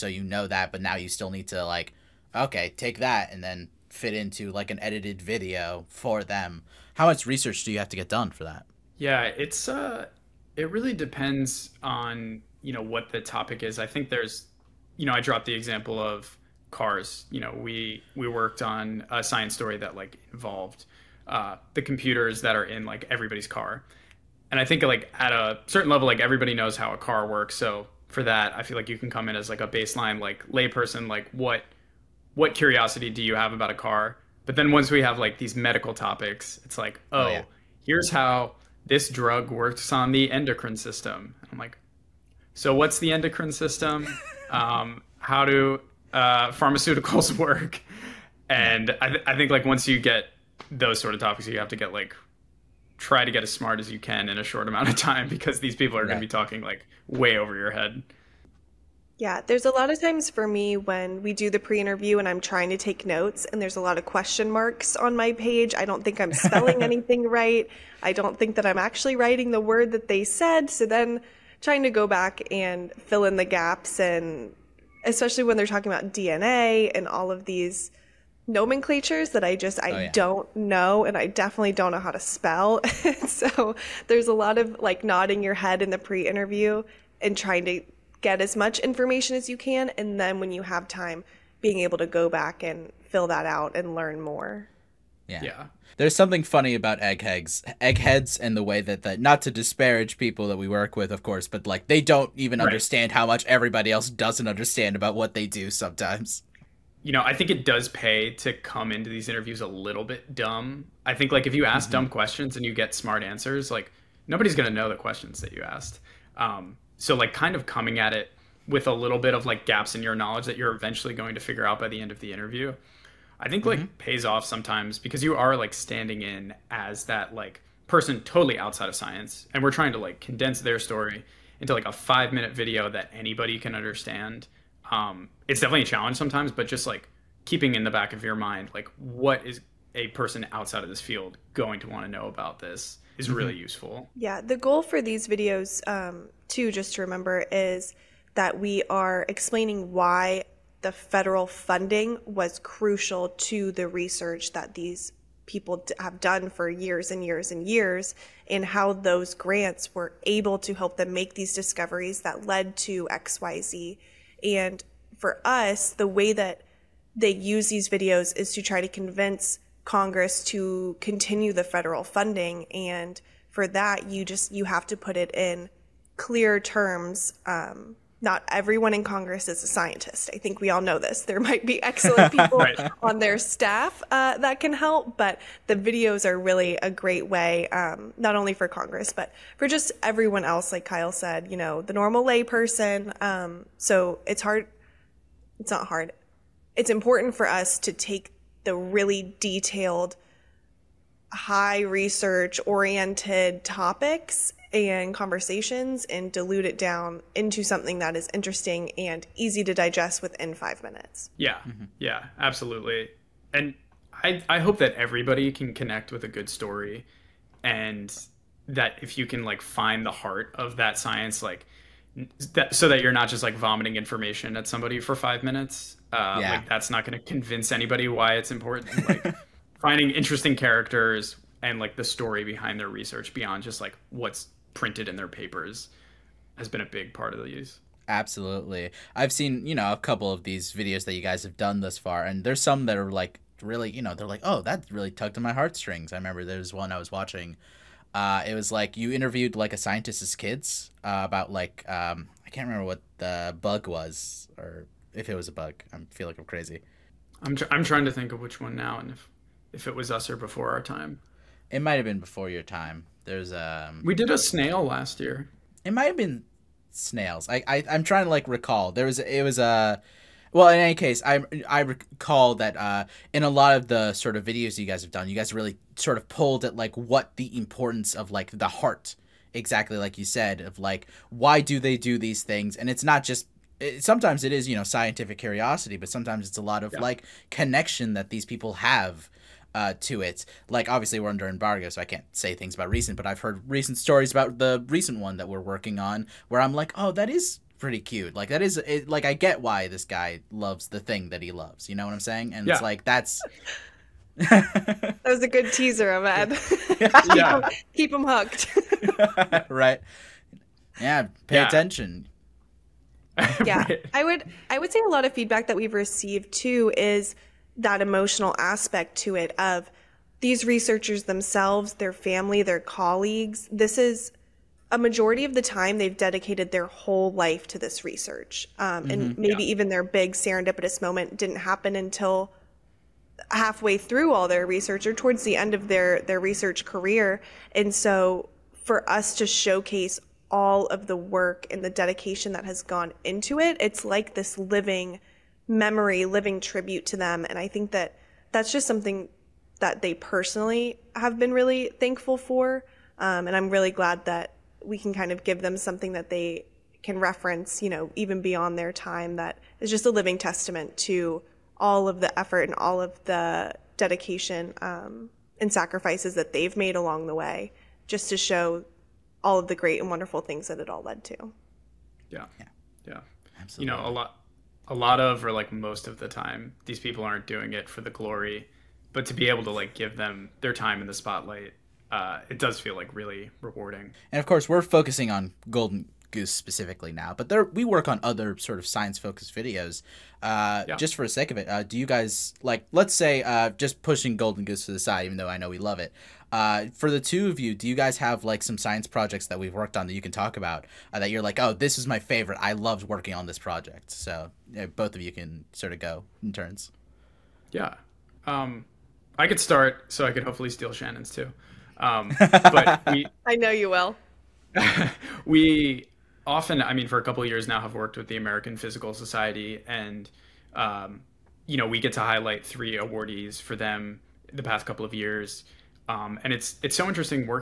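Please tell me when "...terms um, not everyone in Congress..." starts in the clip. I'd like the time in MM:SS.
02:56.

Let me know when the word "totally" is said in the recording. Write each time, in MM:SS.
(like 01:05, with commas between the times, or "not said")
02:08.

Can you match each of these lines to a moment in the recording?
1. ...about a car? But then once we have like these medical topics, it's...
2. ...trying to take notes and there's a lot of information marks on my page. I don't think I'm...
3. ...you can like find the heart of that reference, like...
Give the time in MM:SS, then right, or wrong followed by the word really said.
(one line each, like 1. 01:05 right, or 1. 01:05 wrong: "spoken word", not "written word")
1. 00:33 right
2. 01:02 wrong: "question", not "information"
3. 03:39 wrong: "science", not "reference".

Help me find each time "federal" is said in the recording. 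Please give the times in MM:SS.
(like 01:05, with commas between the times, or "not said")
02:30, 02:51.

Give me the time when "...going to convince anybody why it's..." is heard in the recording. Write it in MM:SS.
03:47.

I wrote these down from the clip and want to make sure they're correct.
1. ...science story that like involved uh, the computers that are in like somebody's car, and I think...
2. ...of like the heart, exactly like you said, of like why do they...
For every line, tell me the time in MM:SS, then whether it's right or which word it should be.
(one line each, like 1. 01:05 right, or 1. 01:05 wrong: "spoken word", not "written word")
1. 00:19 wrong: "everybody", not "somebody"
2. 04:38 right.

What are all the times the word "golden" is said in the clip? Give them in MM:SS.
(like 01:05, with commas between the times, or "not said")
06:25, 06:34.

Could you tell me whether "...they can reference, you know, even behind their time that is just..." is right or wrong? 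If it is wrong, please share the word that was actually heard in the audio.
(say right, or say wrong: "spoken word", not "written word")
wrong: "beyond", not "behind".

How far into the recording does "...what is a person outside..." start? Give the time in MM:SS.
02:18.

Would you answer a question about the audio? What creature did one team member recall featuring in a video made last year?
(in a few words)
snail.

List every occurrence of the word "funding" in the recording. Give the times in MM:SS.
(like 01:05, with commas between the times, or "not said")
02:31, 02:52.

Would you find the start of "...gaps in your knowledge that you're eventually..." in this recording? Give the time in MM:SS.
01:59.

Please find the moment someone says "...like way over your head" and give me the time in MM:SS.
00:56.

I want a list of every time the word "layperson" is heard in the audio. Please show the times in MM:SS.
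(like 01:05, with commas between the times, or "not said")
00:30, 03:12.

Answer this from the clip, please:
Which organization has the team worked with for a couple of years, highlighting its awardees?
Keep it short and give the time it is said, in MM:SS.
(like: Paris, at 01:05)
American Physical Society, at 06:58.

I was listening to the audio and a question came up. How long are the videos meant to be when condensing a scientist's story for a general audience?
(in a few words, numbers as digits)
5 minutes.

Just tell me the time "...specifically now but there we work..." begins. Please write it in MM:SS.
06:26.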